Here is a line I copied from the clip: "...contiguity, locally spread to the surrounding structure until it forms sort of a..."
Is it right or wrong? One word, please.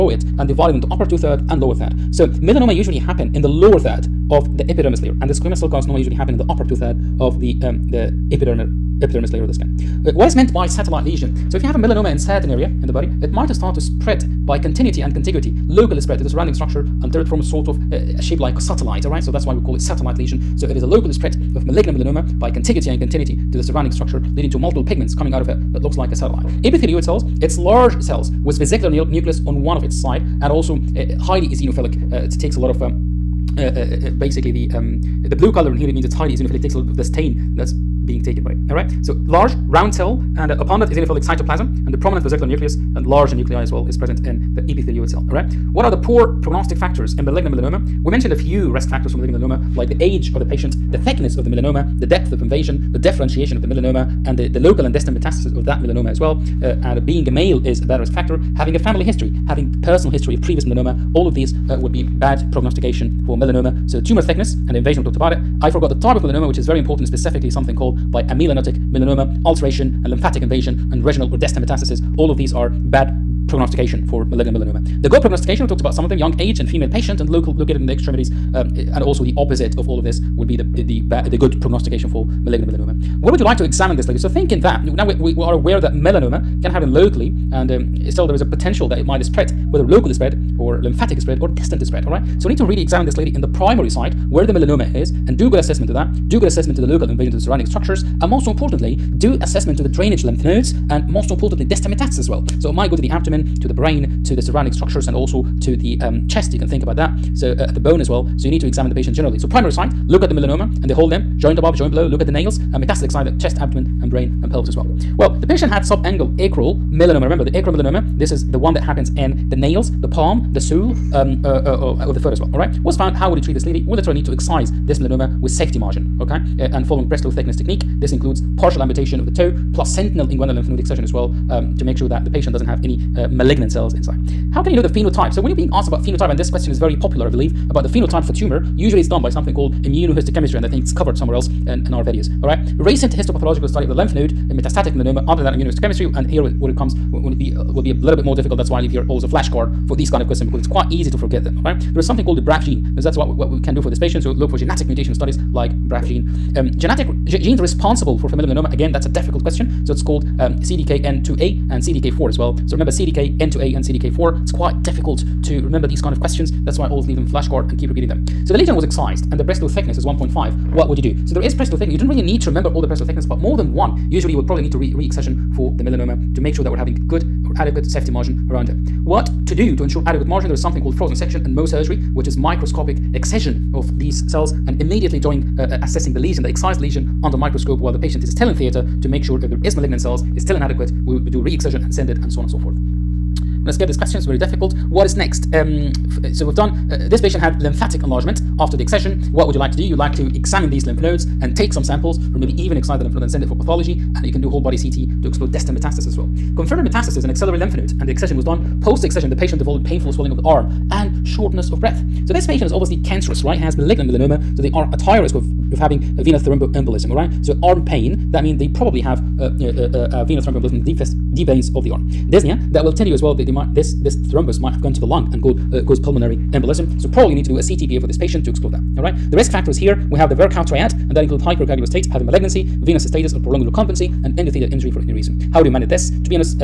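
right.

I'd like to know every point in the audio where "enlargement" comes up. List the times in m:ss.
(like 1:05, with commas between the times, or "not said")
3:18.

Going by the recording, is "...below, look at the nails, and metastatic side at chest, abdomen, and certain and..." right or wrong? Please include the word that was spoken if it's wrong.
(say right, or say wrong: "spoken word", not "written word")
wrong: "brain", not "certain".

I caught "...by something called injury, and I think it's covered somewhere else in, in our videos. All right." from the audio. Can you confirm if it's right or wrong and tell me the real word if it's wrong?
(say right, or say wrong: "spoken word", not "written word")
wrong: "immunohistochemistry", not "injury".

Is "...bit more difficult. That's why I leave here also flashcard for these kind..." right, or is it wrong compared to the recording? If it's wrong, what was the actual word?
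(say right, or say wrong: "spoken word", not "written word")
right.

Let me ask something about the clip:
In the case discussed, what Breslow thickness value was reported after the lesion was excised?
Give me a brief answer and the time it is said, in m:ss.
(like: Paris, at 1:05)
1.5, at 2:50.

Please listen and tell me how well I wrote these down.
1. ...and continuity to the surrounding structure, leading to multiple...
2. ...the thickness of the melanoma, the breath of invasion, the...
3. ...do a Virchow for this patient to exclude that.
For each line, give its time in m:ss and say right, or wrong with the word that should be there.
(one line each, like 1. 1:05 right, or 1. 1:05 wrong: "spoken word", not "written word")
1. 0:22 right
2. 0:50 wrong: "depth", not "breath"
3. 3:47 wrong: "CTPA", not "Virchow".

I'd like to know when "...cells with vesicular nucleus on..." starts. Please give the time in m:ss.
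0:28.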